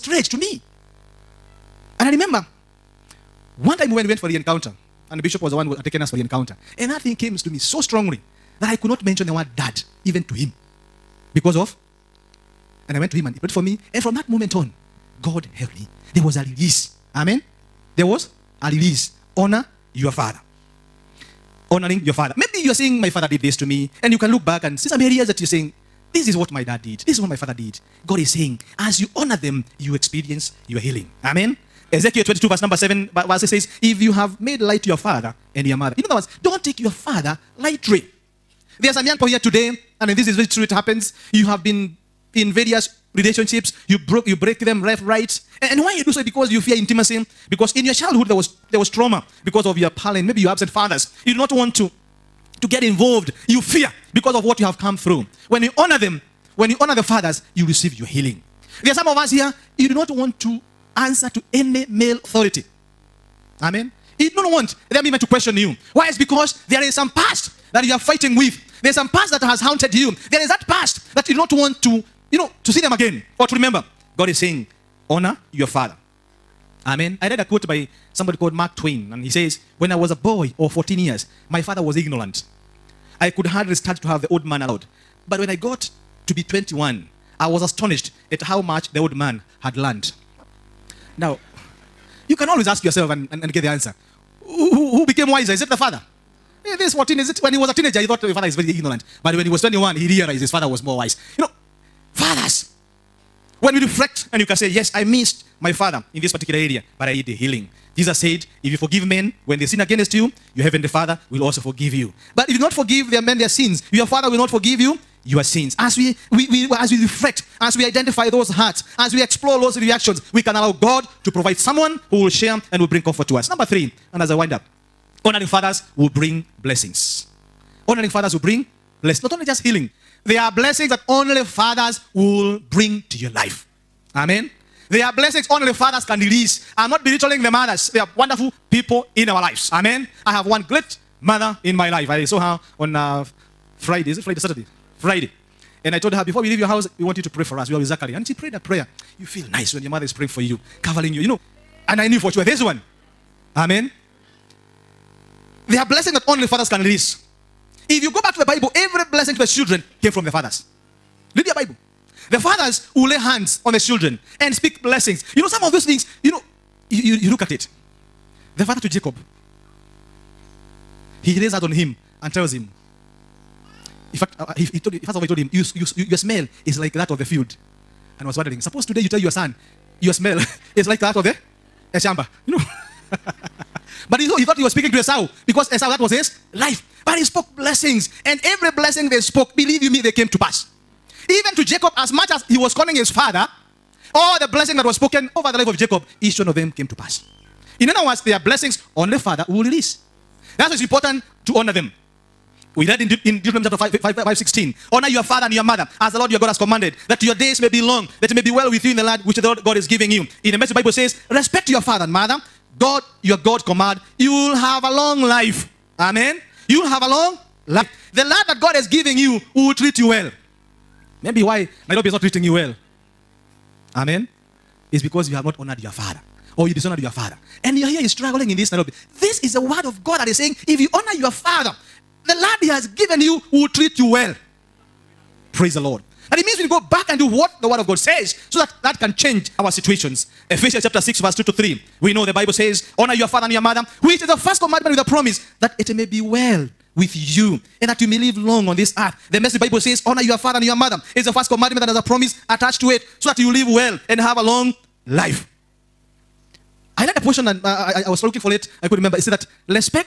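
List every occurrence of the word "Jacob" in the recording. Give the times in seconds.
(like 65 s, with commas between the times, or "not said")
168 s, 191 s, 195 s.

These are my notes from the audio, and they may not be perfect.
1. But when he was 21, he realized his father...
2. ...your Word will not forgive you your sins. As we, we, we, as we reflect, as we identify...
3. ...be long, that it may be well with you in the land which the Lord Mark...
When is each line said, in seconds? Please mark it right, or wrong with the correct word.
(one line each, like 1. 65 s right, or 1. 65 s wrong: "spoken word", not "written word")
1. 99 s right
2. 113 s wrong: "Father", not "Word"
3. 207 s wrong: "God", not "Mark".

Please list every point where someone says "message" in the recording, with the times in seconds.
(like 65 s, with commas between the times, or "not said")
210 s, 249 s.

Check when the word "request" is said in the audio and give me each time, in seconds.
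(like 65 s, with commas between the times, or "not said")
not said.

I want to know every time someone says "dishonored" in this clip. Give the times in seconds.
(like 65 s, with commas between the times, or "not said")
226 s.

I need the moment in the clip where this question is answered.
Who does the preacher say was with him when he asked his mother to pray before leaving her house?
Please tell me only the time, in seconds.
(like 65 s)
147 s.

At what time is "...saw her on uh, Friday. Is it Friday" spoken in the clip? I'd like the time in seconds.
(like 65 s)
142 s.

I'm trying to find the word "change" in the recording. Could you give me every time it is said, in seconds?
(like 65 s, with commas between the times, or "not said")
239 s.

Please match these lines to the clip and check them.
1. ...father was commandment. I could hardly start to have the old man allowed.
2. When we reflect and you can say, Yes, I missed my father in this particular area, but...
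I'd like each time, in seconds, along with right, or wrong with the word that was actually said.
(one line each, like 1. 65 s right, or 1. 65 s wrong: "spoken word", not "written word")
1. 81 s wrong: "ignorant", not "commandment"
2. 103 s right.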